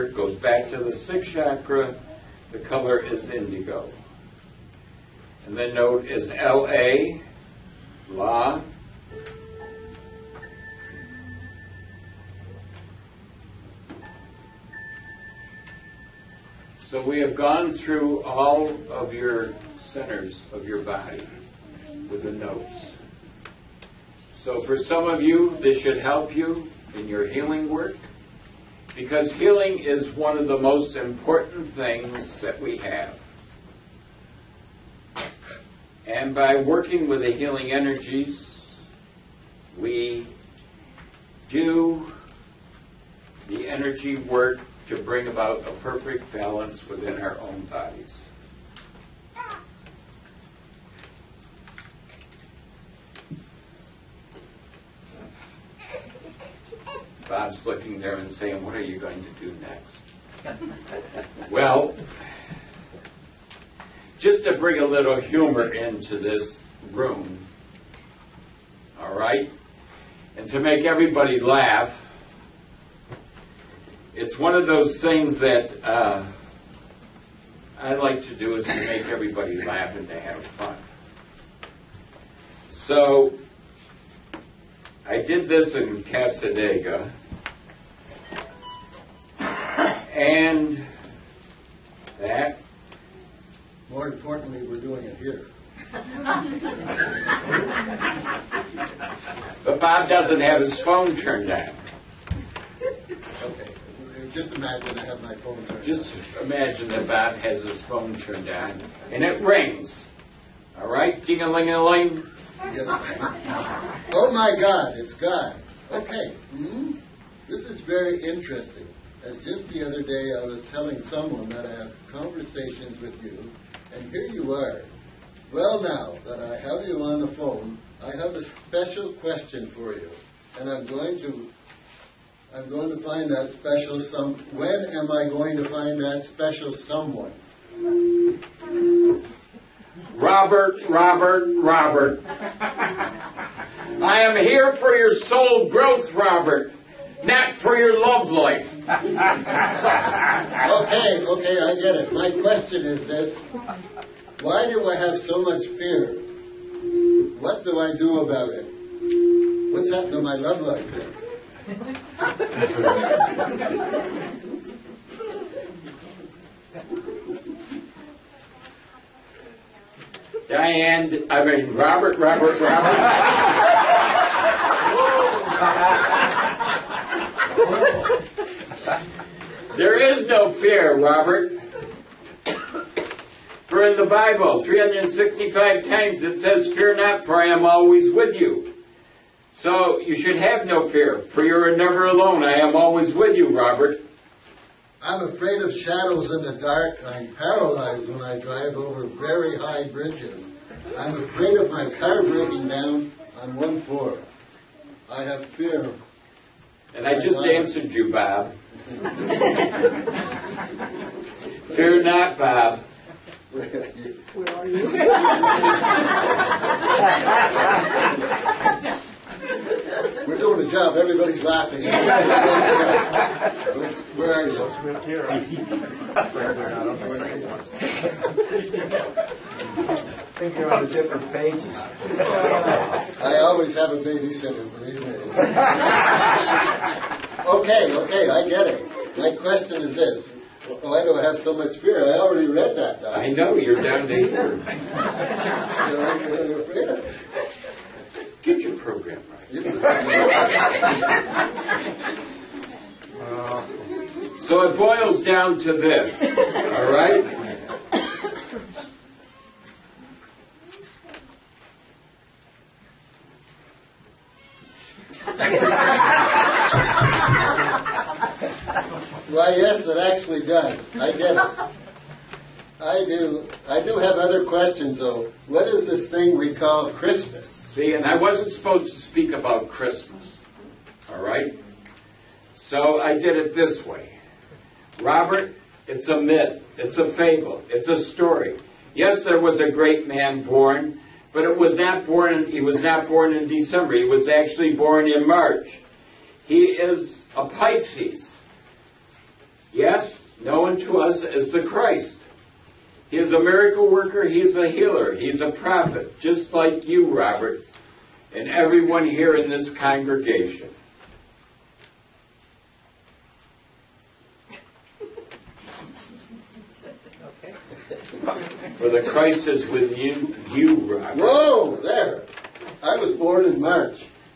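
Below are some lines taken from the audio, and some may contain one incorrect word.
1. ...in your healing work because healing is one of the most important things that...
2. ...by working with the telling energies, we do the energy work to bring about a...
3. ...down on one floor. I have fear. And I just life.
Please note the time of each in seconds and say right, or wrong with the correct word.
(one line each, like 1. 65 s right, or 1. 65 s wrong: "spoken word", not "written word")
1. 26 s right
2. 36 s wrong: "healing", not "telling"
3. 202 s right.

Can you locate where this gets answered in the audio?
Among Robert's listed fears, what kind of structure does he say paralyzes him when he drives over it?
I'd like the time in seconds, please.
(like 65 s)
199 s.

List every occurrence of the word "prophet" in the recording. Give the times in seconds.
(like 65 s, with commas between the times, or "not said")
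305 s.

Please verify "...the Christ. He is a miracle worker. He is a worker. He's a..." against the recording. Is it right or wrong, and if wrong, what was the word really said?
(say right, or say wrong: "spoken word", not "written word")
wrong: "healer", not "worker".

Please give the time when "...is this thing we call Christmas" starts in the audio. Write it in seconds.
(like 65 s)
275 s.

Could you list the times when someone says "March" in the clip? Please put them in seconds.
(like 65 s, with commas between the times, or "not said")
295 s, 323 s.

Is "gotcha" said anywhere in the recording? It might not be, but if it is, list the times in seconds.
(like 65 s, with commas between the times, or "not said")
not said.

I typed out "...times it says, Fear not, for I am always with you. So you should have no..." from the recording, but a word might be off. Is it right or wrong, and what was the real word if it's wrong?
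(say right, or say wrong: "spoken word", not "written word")
right.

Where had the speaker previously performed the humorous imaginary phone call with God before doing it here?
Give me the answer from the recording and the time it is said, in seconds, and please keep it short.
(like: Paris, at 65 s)
Cassadaga, at 86 s.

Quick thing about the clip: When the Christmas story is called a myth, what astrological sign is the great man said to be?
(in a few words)
Pisces.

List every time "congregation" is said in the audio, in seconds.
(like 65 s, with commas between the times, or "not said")
309 s.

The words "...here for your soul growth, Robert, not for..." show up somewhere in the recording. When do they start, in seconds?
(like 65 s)
144 s.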